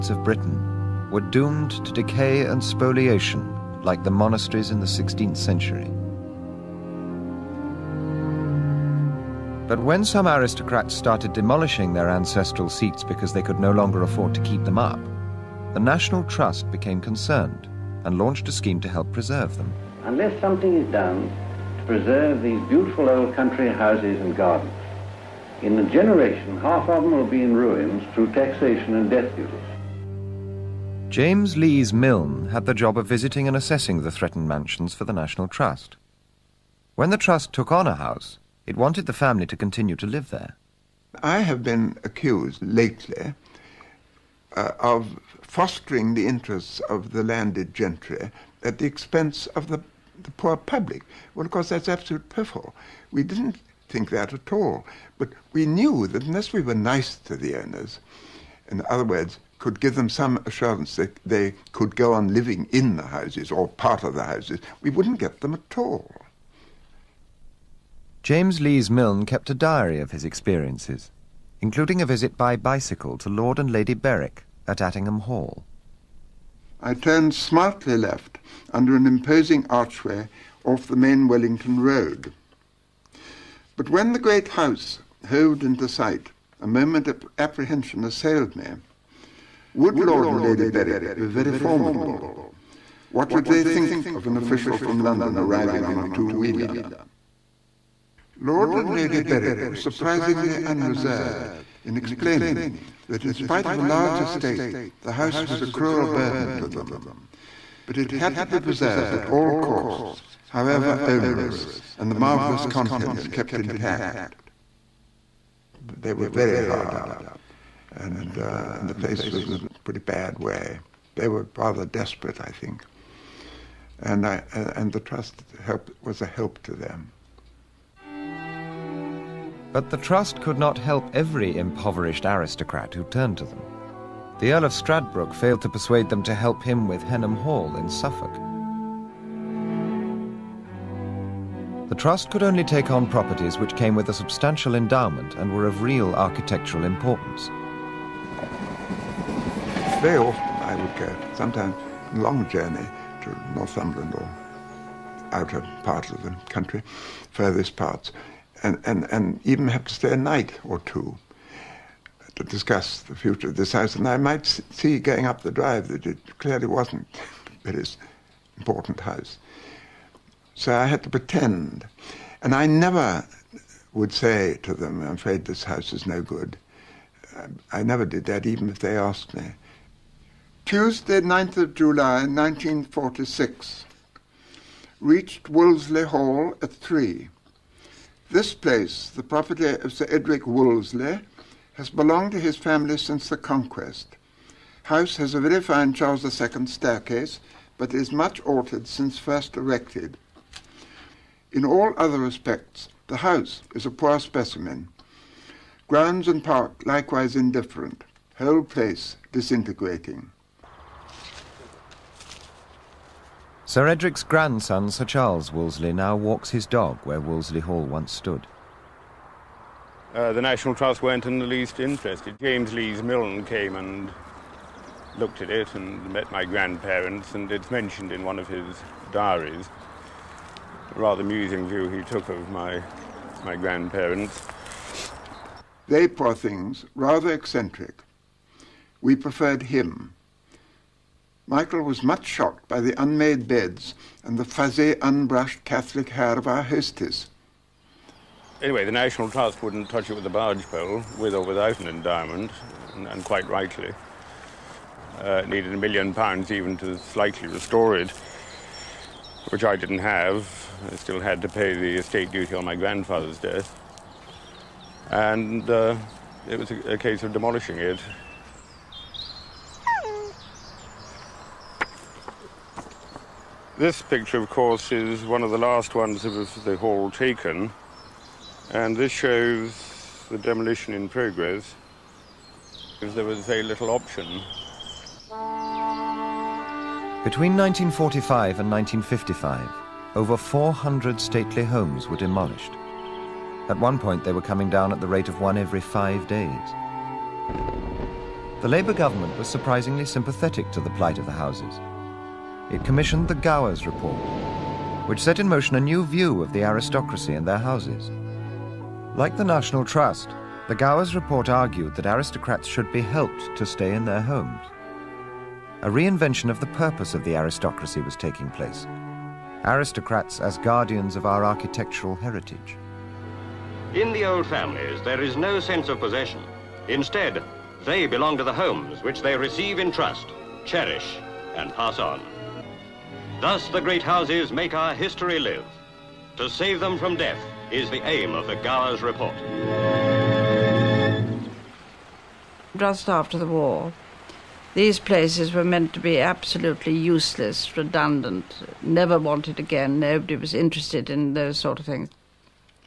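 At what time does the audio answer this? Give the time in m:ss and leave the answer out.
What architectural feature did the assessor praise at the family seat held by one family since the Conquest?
3:15.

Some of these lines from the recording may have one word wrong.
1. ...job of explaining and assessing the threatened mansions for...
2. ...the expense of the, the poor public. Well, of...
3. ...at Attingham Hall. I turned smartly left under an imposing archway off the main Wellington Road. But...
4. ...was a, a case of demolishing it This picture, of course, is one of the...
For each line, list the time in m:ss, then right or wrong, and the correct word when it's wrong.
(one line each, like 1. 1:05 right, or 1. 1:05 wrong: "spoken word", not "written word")
1. 0:32 wrong: "visiting", not "explaining"
2. 0:48 right
3. 1:14 right
4. 4:26 right.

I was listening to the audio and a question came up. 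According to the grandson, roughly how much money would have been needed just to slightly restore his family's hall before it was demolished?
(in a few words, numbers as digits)
a million pounds.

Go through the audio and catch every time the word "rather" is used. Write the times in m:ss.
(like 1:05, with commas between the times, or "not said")
2:01, 3:50, 3:56.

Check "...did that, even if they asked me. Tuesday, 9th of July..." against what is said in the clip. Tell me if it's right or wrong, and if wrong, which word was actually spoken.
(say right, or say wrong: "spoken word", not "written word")
right.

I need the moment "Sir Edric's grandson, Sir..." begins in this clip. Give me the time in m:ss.
3:33.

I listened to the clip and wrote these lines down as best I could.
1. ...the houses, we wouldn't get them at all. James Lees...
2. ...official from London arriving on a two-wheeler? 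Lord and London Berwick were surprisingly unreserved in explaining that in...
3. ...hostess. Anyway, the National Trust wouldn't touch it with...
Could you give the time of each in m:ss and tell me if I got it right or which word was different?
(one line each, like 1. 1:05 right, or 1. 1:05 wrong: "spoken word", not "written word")
1. 1:04 right
2. 1:34 wrong: "Lady", not "London"
3. 4:06 right.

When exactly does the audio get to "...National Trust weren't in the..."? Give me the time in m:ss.
3:40.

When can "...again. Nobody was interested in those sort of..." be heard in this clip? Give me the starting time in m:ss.
5:49.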